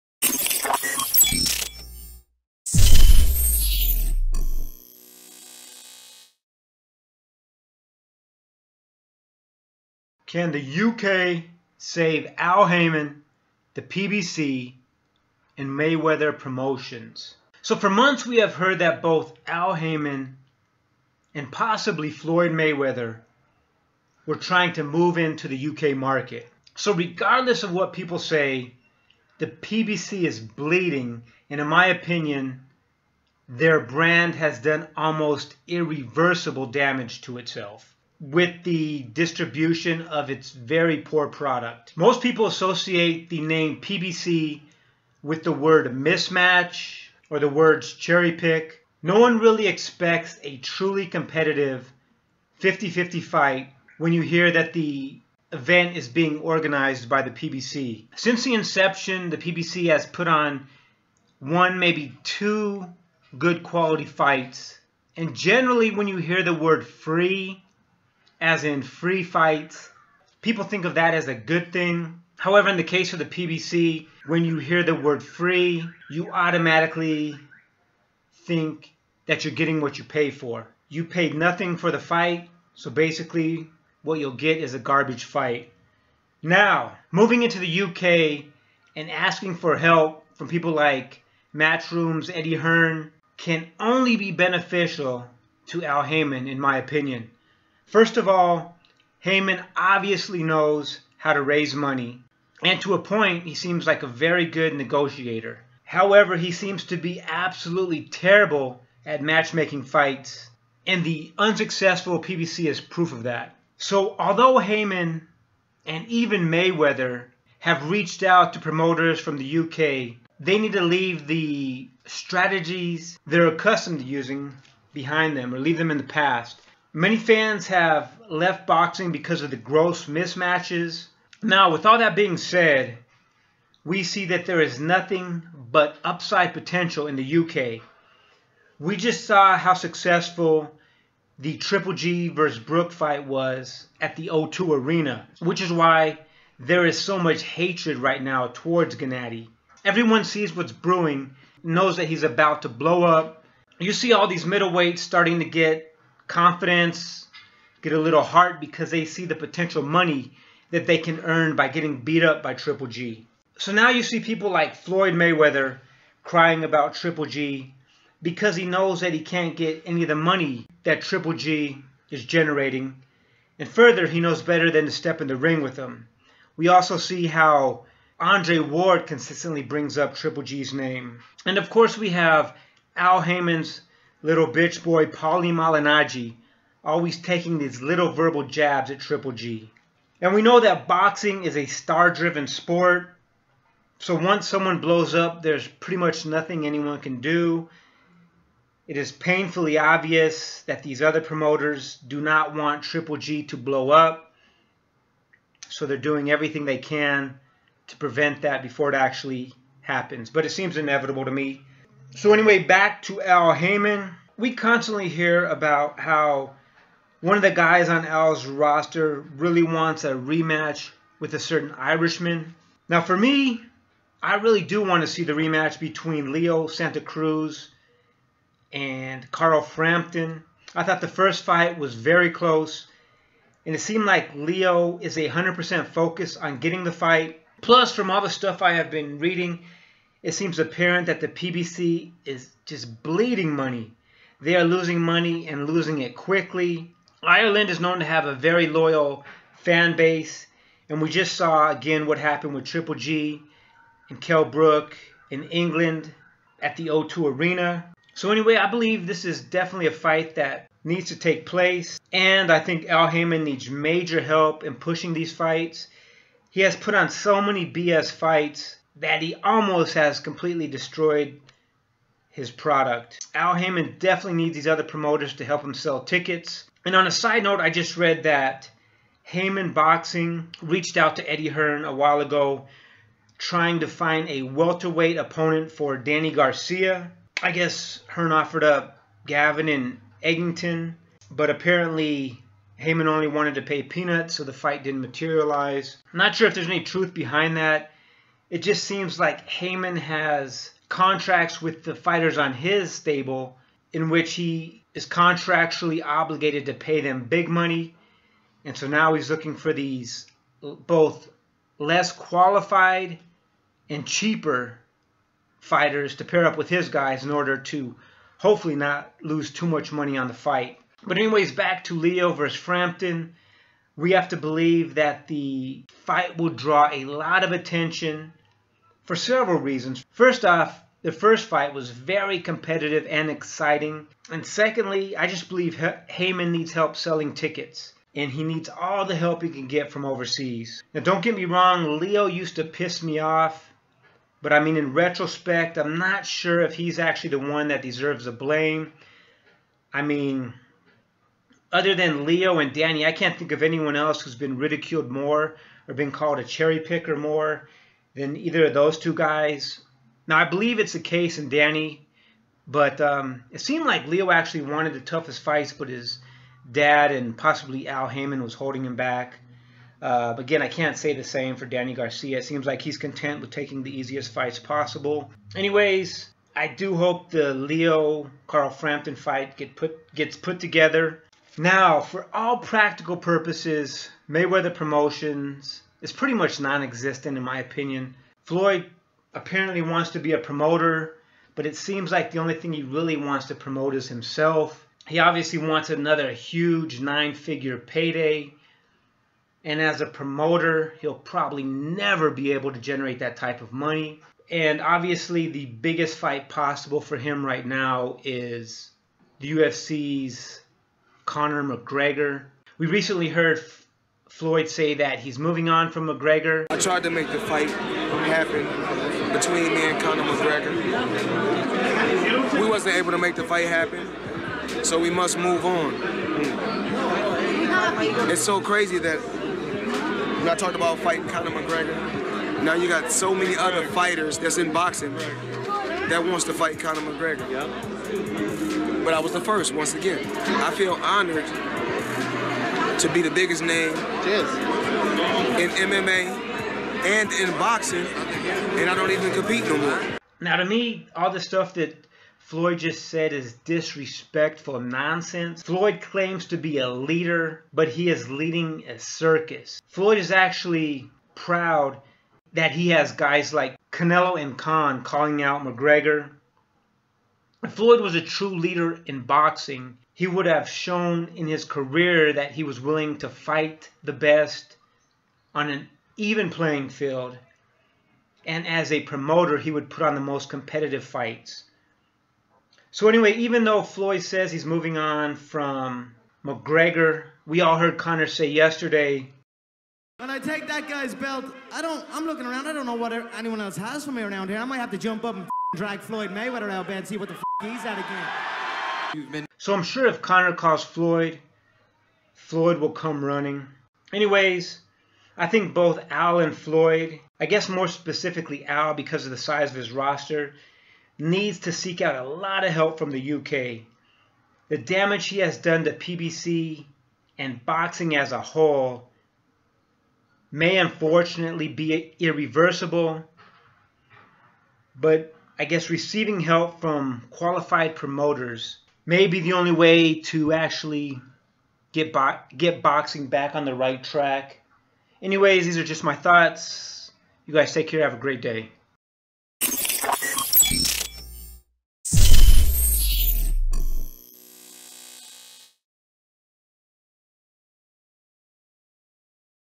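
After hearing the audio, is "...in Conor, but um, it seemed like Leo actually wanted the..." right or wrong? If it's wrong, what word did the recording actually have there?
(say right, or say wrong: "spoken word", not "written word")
wrong: "Danny", not "Conor".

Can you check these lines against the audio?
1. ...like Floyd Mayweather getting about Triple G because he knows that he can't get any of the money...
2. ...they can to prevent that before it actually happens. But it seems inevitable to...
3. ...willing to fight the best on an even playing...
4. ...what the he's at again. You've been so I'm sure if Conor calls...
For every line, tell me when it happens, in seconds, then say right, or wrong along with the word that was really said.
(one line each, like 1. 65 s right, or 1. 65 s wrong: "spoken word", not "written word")
1. 164 s wrong: "crying", not "getting"
2. 206 s right
3. 472 s right
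4. 497 s right.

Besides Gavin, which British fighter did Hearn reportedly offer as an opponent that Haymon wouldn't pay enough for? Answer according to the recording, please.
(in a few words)
Eggington.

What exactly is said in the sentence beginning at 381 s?
Now, for all practical purposes, Mayweather Promotions is pretty much non-existent in my opinion.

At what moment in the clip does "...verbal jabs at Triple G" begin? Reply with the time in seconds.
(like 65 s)
188 s.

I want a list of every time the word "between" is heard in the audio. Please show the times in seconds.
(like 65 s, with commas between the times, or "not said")
225 s, 419 s.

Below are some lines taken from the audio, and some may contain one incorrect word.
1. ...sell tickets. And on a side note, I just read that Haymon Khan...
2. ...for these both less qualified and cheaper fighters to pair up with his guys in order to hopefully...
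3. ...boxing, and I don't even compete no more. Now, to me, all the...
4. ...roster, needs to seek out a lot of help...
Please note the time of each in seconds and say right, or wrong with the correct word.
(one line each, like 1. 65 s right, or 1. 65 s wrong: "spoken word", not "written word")
1. 275 s wrong: "Boxing", not "Khan"
2. 309 s right
3. 447 s right
4. 509 s right.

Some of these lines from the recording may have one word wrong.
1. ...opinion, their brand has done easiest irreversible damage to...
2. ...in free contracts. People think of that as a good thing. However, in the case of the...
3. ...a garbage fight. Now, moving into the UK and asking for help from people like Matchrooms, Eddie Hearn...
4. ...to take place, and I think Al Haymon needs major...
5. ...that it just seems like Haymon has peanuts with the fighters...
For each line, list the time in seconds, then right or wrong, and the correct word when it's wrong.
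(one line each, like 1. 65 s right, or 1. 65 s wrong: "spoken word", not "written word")
1. 31 s wrong: "almost", not "easiest"
2. 68 s wrong: "fights", not "contracts"
3. 84 s right
4. 261 s right
5. 297 s wrong: "contracts", not "peanuts".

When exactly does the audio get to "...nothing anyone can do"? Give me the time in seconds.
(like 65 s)
196 s.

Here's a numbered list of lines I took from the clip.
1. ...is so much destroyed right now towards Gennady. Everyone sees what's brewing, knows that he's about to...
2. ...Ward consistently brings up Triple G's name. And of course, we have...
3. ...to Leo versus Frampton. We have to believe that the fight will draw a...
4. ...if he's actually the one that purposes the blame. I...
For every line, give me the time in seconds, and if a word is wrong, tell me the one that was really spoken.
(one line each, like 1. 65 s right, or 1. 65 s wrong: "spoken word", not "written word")
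1. 146 s wrong: "hatred", not "destroyed"
2. 178 s right
3. 321 s right
4. 346 s wrong: "deserves", not "purposes".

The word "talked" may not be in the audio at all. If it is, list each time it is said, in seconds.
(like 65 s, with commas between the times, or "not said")
430 s.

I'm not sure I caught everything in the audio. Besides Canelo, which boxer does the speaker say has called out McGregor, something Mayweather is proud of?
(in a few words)
Khan.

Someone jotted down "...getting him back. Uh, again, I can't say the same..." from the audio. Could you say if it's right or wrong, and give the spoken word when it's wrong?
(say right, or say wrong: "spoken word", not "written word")
wrong: "holding", not "getting".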